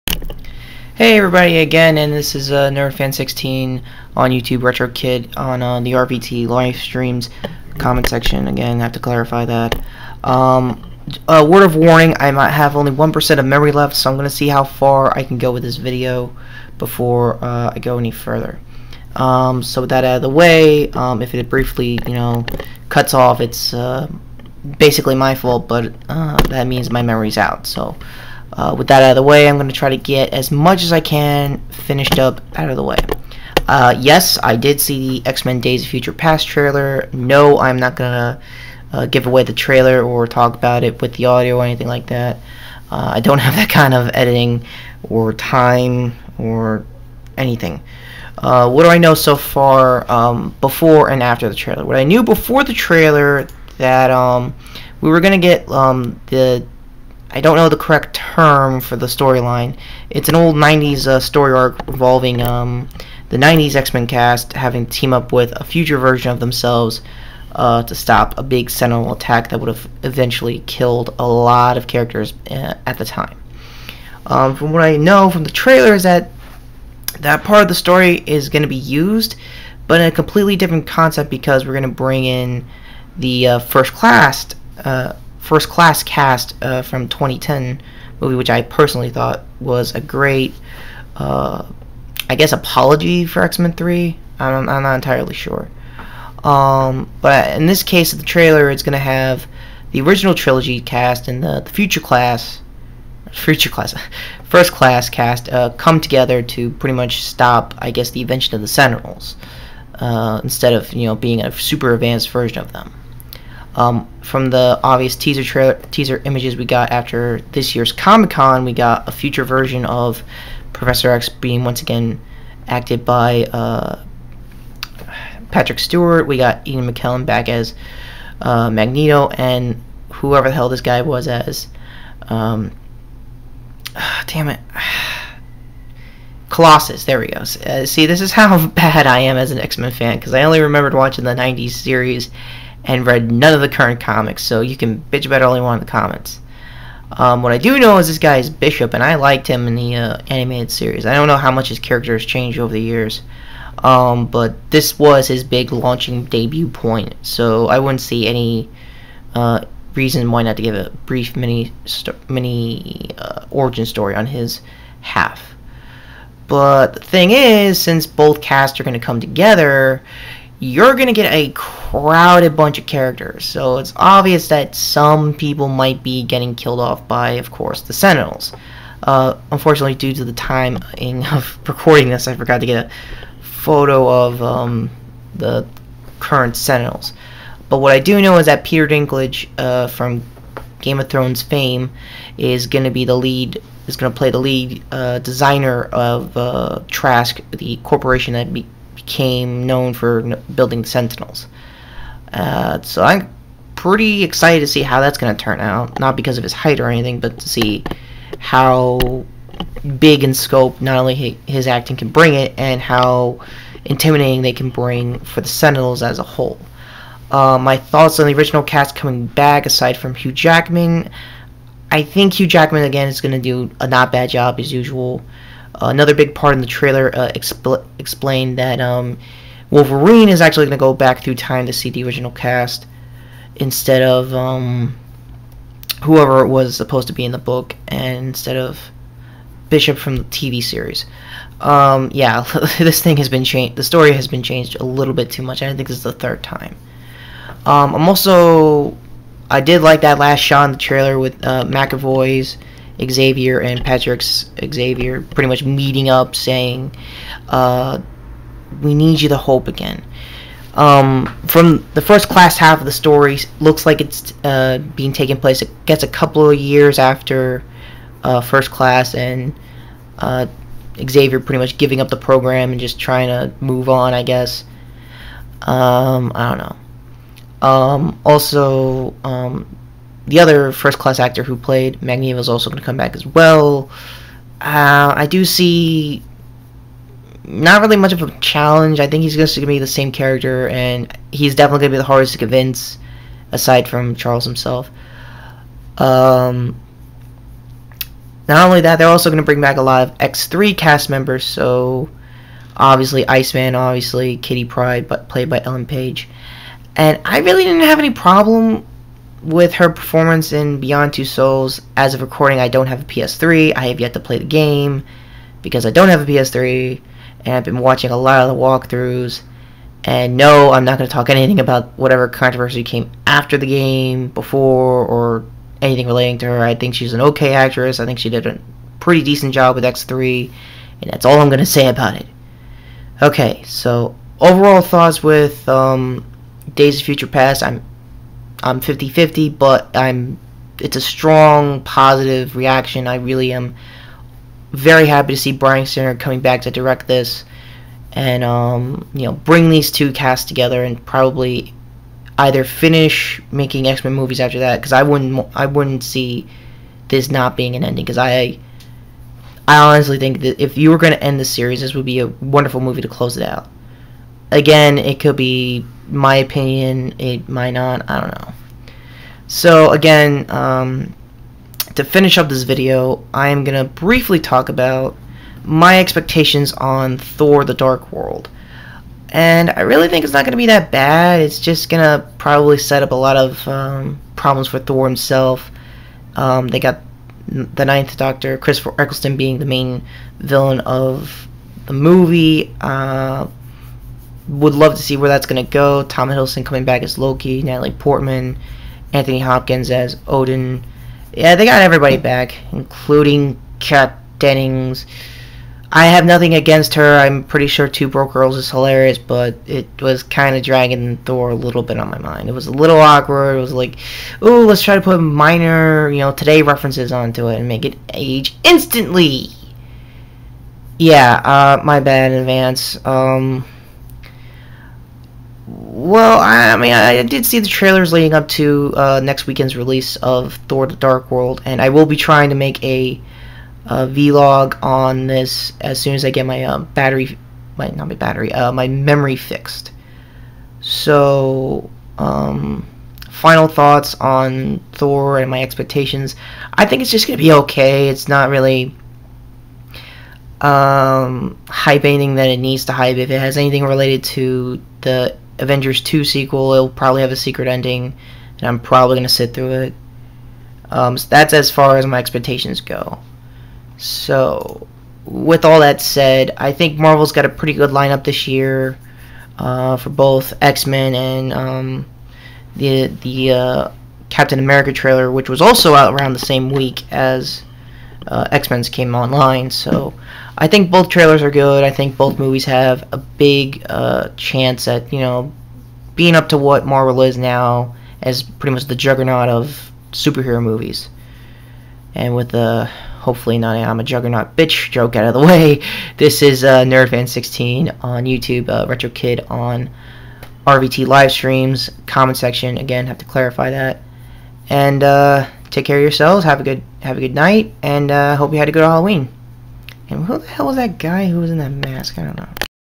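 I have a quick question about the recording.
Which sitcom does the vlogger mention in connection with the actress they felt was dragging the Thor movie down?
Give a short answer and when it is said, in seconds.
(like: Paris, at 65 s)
Two Broke Girls, at 407 s.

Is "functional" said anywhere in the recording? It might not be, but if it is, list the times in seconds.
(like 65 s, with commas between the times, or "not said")
not said.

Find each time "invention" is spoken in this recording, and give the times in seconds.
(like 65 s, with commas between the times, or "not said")
108 s.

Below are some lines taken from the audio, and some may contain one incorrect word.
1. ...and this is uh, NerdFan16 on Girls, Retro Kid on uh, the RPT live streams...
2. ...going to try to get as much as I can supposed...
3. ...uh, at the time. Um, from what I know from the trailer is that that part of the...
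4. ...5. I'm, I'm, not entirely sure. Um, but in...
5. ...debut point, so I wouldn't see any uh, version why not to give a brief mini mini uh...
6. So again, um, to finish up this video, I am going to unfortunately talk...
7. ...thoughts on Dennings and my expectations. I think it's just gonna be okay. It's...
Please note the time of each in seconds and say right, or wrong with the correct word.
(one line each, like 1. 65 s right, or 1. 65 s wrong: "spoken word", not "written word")
1. 1 s wrong: "YouTube", not "Girls"
2. 29 s wrong: "finished", not "supposed"
3. 72 s right
4. 93 s wrong: "3", not "5"
5. 156 s wrong: "reason", not "version"
6. 369 s wrong: "briefly", not "unfortunately"
7. 443 s wrong: "Thor", not "Dennings".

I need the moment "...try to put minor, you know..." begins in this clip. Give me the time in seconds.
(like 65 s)
414 s.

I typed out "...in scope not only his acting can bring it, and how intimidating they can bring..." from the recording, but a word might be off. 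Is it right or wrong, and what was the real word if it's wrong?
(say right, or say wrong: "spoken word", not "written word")
right.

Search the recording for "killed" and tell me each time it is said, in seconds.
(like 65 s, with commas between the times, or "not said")
70 s, 176 s.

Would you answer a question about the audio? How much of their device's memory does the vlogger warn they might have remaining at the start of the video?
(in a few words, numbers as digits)
1%.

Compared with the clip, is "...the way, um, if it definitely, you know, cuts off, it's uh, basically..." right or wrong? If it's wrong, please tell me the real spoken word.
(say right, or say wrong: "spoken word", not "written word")
wrong: "briefly", not "definitely".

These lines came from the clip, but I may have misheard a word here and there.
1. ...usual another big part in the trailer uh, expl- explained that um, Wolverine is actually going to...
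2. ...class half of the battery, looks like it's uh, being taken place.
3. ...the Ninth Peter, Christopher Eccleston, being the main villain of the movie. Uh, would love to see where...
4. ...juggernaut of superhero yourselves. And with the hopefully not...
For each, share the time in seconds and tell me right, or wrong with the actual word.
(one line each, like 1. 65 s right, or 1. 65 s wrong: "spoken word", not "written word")
1. 224 s right
2. 262 s wrong: "story", not "battery"
3. 387 s wrong: "Doctor", not "Peter"
4. 488 s wrong: "movies", not "yourselves".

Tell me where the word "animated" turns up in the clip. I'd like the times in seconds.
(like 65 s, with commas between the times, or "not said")
150 s.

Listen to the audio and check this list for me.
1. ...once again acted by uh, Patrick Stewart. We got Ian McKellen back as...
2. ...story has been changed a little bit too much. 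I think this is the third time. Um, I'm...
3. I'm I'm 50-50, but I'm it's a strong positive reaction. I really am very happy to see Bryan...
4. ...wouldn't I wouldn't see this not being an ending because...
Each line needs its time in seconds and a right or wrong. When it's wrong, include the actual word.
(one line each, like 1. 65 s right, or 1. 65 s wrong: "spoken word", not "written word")
1. 121 s right
2. 243 s right
3. 337 s right
4. 355 s right.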